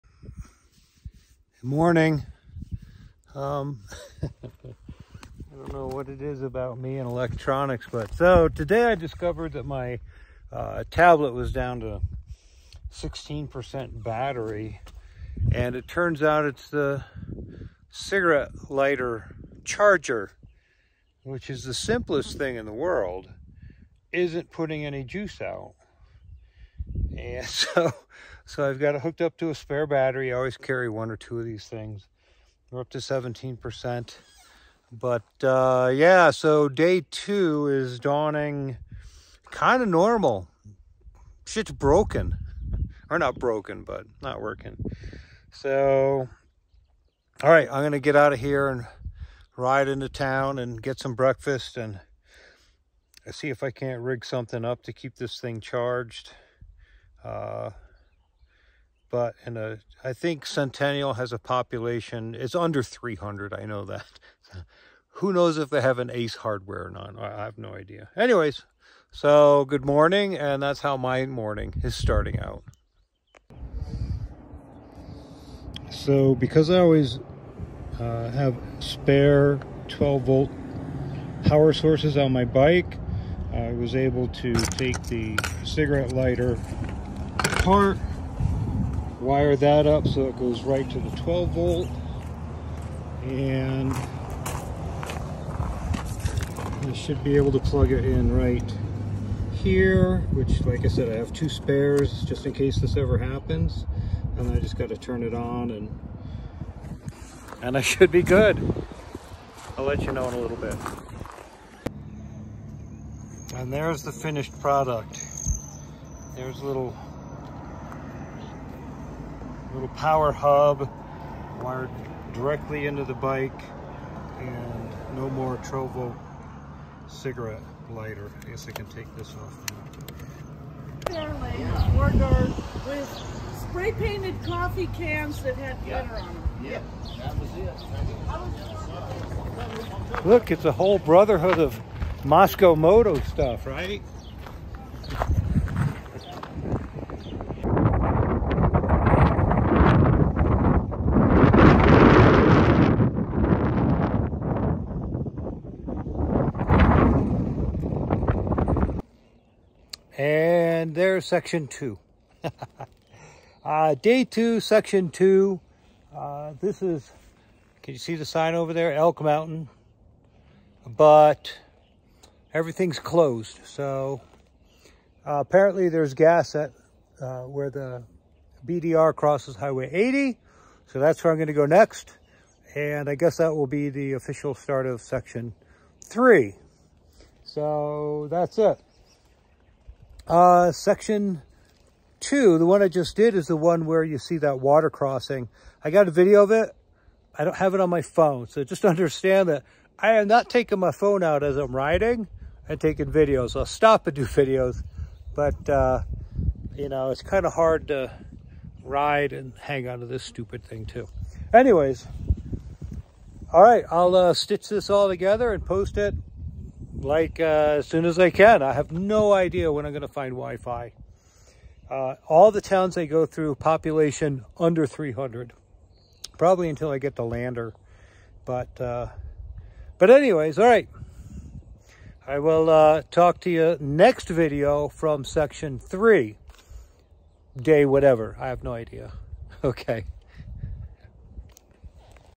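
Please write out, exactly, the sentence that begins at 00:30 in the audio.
I always carry one or two of these things.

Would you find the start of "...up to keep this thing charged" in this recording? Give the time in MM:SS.
00:54.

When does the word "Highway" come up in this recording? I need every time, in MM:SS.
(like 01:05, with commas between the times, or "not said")
02:59.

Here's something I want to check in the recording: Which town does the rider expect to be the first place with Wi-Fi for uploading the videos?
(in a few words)
Lander.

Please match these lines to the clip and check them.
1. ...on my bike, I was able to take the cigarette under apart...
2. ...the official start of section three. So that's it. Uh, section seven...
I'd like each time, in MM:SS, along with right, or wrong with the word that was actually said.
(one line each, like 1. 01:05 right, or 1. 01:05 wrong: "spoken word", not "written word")
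1. 01:22 wrong: "lighter", not "under"
2. 03:03 wrong: "two", not "seven".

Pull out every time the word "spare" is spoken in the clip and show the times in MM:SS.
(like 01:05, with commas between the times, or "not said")
00:29, 01:18, 01:41.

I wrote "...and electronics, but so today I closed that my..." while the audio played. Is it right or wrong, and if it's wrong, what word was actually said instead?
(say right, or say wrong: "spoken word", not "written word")
wrong: "discovered", not "closed".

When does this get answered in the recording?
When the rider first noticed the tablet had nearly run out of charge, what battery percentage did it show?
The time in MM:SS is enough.
00:12.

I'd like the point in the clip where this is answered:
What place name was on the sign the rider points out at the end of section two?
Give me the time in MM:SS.
02:48.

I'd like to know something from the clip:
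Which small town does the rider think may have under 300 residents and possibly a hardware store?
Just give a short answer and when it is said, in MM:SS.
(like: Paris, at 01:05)
Centennial, at 01:00.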